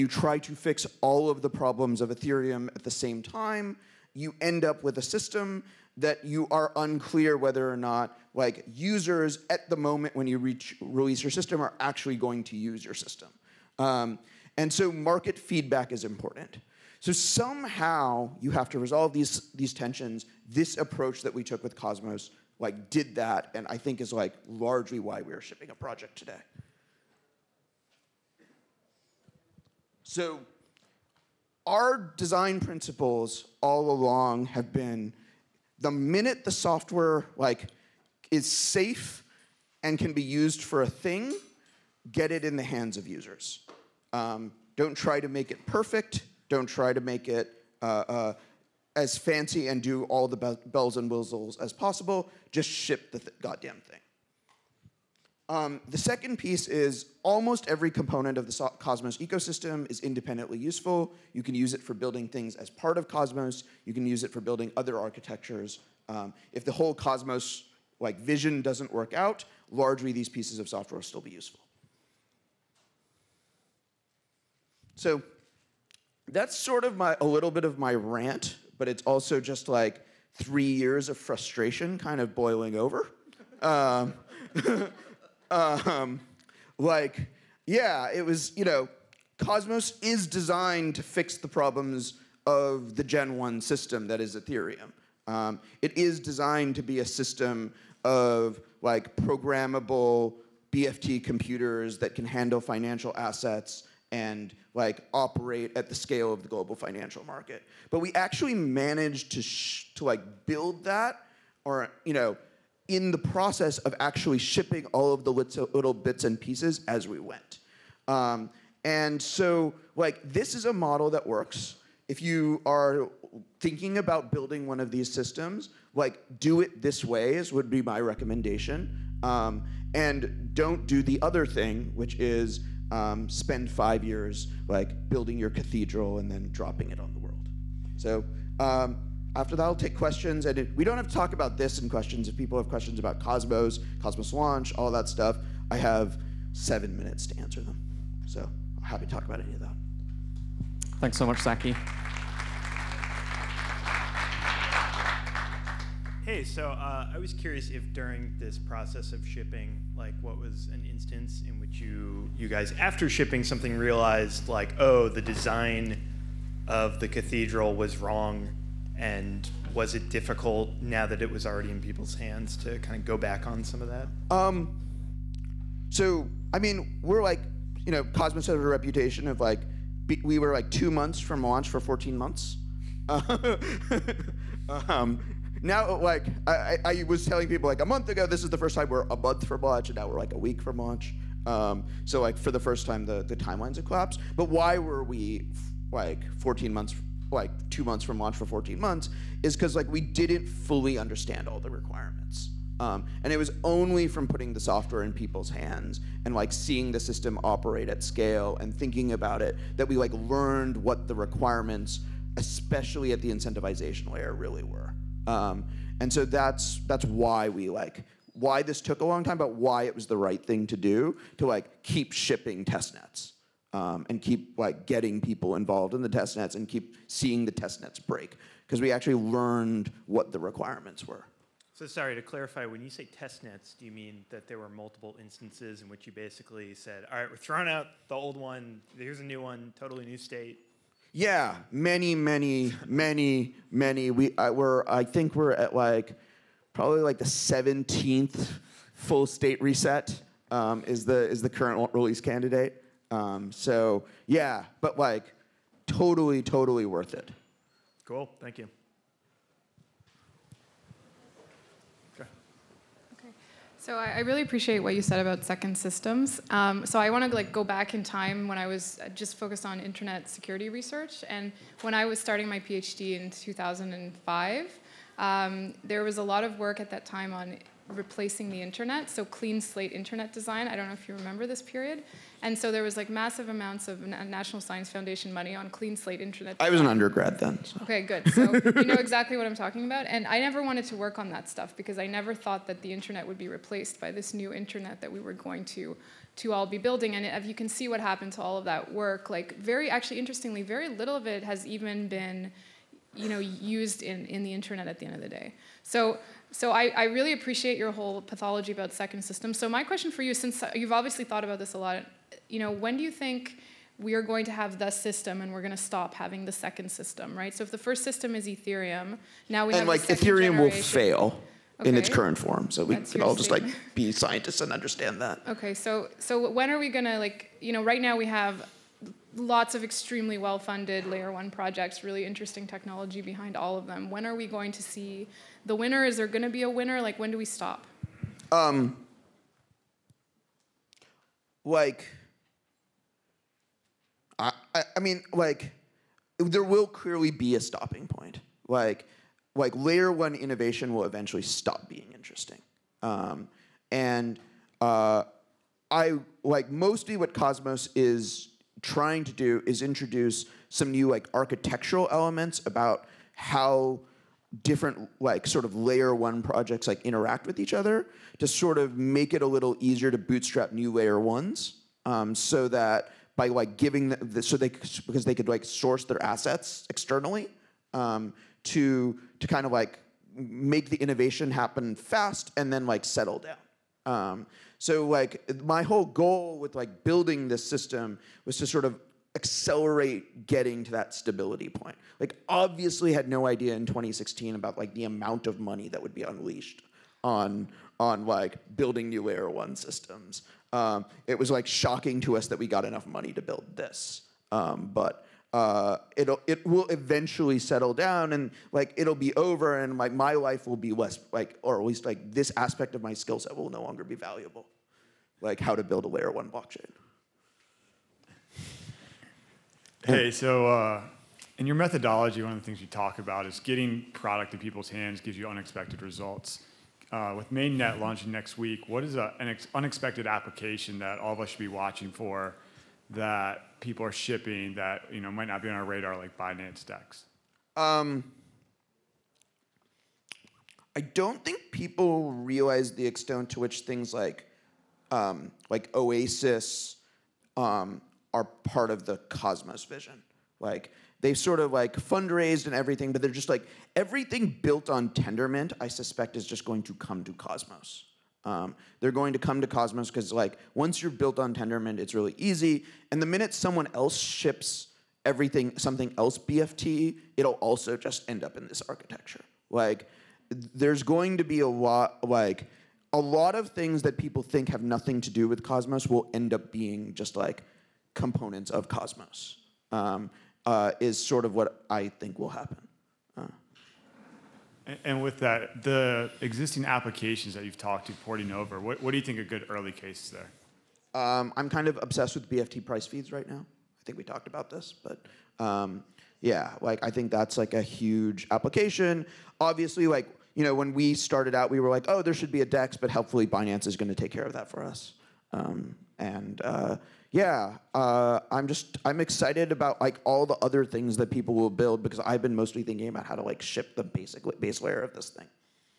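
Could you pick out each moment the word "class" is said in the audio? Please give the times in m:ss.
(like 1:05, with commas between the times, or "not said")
not said.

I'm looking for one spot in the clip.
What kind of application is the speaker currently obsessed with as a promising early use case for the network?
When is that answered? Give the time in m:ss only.
8:12.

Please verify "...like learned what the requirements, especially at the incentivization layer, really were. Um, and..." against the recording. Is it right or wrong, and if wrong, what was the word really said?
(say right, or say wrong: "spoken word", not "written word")
right.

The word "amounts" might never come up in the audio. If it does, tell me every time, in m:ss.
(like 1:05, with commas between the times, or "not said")
4:43, 6:35.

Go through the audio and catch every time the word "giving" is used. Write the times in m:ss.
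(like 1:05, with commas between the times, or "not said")
6:13.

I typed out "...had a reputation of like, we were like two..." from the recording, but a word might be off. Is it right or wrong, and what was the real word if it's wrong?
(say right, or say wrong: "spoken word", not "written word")
right.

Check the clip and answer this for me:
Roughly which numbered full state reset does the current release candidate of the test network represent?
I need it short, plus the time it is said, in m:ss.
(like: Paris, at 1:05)
17th, at 4:07.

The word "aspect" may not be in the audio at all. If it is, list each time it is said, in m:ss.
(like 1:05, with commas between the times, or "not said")
6:52.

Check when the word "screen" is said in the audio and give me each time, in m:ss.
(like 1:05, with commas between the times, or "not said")
not said.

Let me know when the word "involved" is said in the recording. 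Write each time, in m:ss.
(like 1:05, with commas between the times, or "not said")
3:45.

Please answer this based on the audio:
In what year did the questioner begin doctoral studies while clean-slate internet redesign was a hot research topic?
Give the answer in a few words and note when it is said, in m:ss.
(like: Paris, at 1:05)
2005, at 4:33.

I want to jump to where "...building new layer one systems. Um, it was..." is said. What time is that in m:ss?
6:38.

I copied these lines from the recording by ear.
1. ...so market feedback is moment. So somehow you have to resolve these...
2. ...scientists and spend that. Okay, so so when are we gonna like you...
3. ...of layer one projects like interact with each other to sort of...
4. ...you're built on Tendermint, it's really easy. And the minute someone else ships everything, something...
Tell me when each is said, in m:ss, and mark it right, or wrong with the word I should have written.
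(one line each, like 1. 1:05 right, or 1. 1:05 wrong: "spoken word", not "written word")
1. 0:14 wrong: "important", not "moment"
2. 5:24 wrong: "understand", not "spend"
3. 6:05 right
4. 7:41 right.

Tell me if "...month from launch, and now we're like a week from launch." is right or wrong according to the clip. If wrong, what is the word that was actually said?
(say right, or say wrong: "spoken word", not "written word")
right.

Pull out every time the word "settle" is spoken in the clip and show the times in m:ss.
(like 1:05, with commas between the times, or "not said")
6:23, 6:47.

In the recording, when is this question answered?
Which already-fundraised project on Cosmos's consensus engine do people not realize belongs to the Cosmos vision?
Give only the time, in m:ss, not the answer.
7:25.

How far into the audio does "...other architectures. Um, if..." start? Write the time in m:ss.
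1:04.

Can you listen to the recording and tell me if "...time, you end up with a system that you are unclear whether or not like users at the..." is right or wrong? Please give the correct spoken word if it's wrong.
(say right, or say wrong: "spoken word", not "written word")
right.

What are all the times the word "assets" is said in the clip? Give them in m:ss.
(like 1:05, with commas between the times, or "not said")
1:43, 6:16.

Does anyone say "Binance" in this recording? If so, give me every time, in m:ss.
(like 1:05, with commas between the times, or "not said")
7:16, 8:23.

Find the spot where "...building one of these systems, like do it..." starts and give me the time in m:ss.
2:04.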